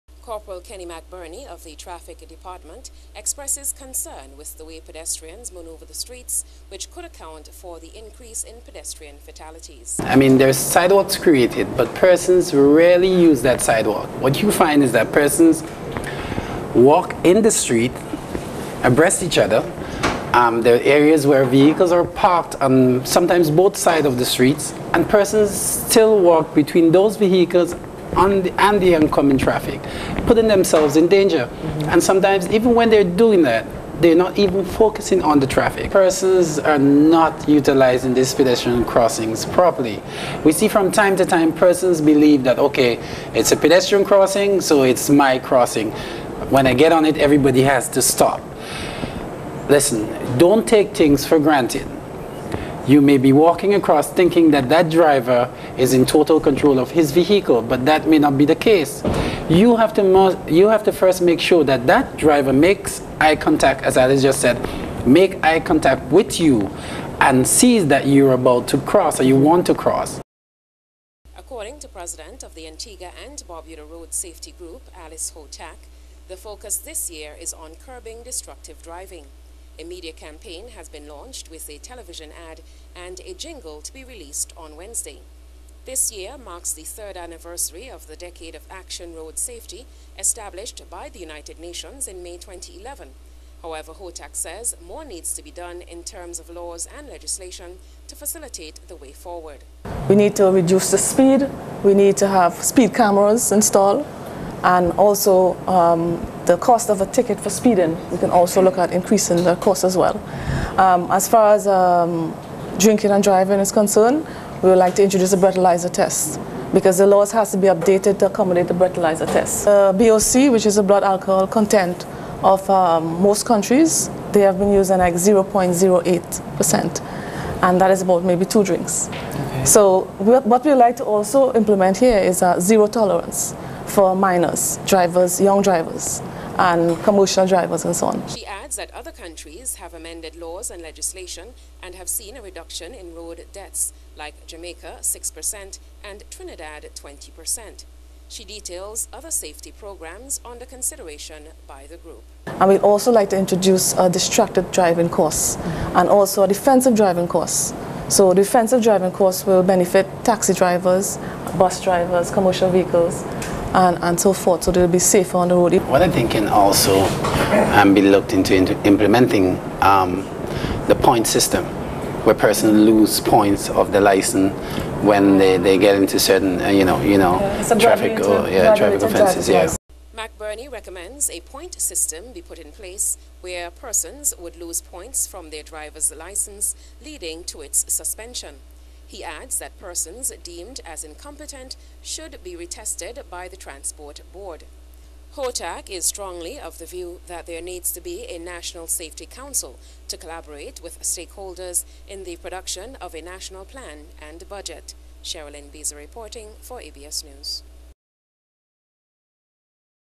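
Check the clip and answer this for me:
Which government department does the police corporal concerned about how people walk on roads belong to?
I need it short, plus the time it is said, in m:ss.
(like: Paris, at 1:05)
Traffic Department, at 0:01.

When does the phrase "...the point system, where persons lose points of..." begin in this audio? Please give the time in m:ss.
2:50.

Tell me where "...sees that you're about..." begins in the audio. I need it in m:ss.
1:07.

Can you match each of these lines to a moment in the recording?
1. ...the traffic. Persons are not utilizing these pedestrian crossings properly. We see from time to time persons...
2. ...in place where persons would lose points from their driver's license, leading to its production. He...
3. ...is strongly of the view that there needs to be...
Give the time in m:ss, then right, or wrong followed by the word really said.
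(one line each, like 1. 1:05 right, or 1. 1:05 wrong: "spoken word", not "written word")
1. 0:35 right
2. 3:02 wrong: "suspension", not "production"
3. 3:15 right.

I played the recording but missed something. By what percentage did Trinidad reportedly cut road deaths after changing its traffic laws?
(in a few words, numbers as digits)
20%.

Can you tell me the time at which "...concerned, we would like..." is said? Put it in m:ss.
1:53.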